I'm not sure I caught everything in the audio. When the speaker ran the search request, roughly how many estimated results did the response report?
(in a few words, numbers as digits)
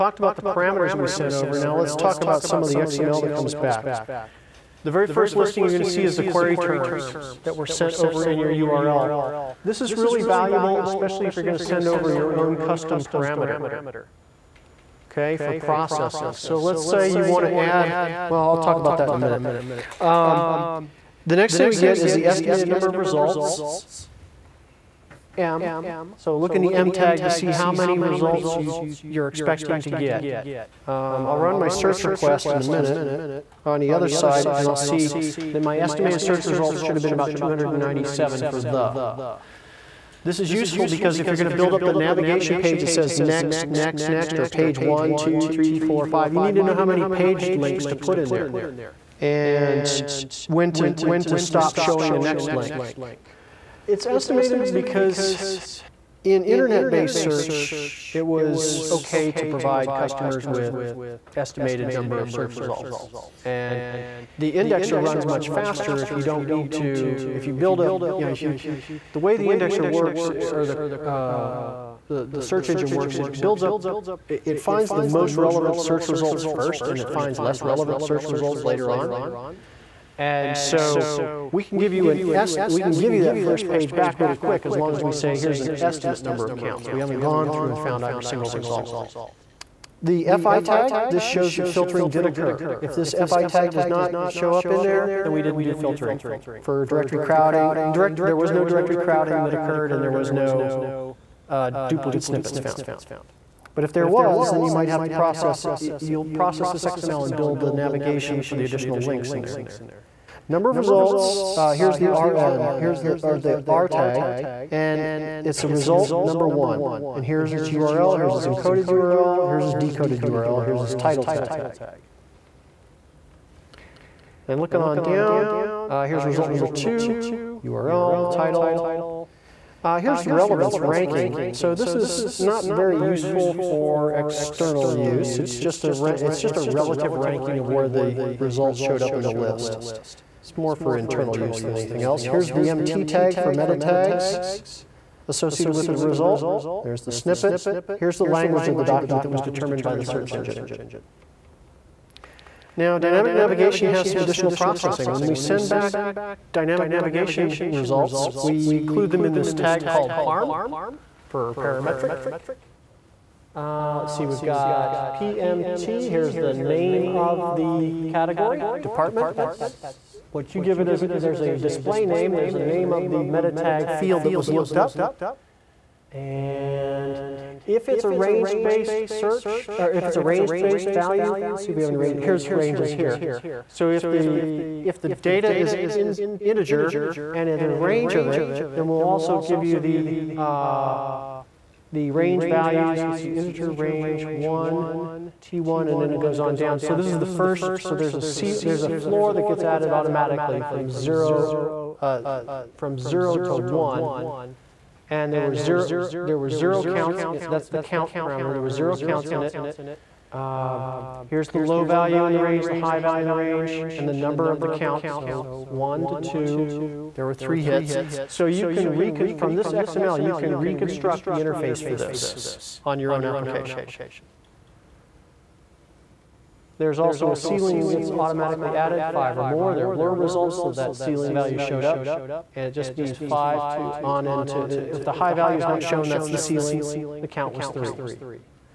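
297.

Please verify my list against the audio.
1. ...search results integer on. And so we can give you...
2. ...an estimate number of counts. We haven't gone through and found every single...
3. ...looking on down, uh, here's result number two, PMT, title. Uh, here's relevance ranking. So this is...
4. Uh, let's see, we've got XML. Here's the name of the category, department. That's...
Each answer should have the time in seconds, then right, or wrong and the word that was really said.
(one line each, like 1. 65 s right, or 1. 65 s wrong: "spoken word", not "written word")
1. 78 s wrong: "later", not "integer"
2. 85 s right
3. 124 s wrong: "URL", not "PMT"
4. 163 s wrong: "PMT", not "XML".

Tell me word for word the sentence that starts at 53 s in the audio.
It's estimated because in internet-based search, it was okay to provide customers with estimated number of search results.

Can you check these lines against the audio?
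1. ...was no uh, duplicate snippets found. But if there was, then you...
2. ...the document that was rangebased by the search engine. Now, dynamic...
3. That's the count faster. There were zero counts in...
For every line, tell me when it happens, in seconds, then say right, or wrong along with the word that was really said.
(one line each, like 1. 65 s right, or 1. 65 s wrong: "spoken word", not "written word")
1. 100 s right
2. 148 s wrong: "determined", not "rangebased"
3. 207 s wrong: "parameter", not "faster".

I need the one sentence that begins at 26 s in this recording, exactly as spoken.
So look in the M tag to see how many results you, you're expecting to get.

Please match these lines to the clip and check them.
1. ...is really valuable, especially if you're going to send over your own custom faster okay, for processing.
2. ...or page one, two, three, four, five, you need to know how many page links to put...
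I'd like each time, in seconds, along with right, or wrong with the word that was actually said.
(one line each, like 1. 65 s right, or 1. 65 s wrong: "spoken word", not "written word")
1. 9 s wrong: "parameter", not "faster"
2. 44 s right.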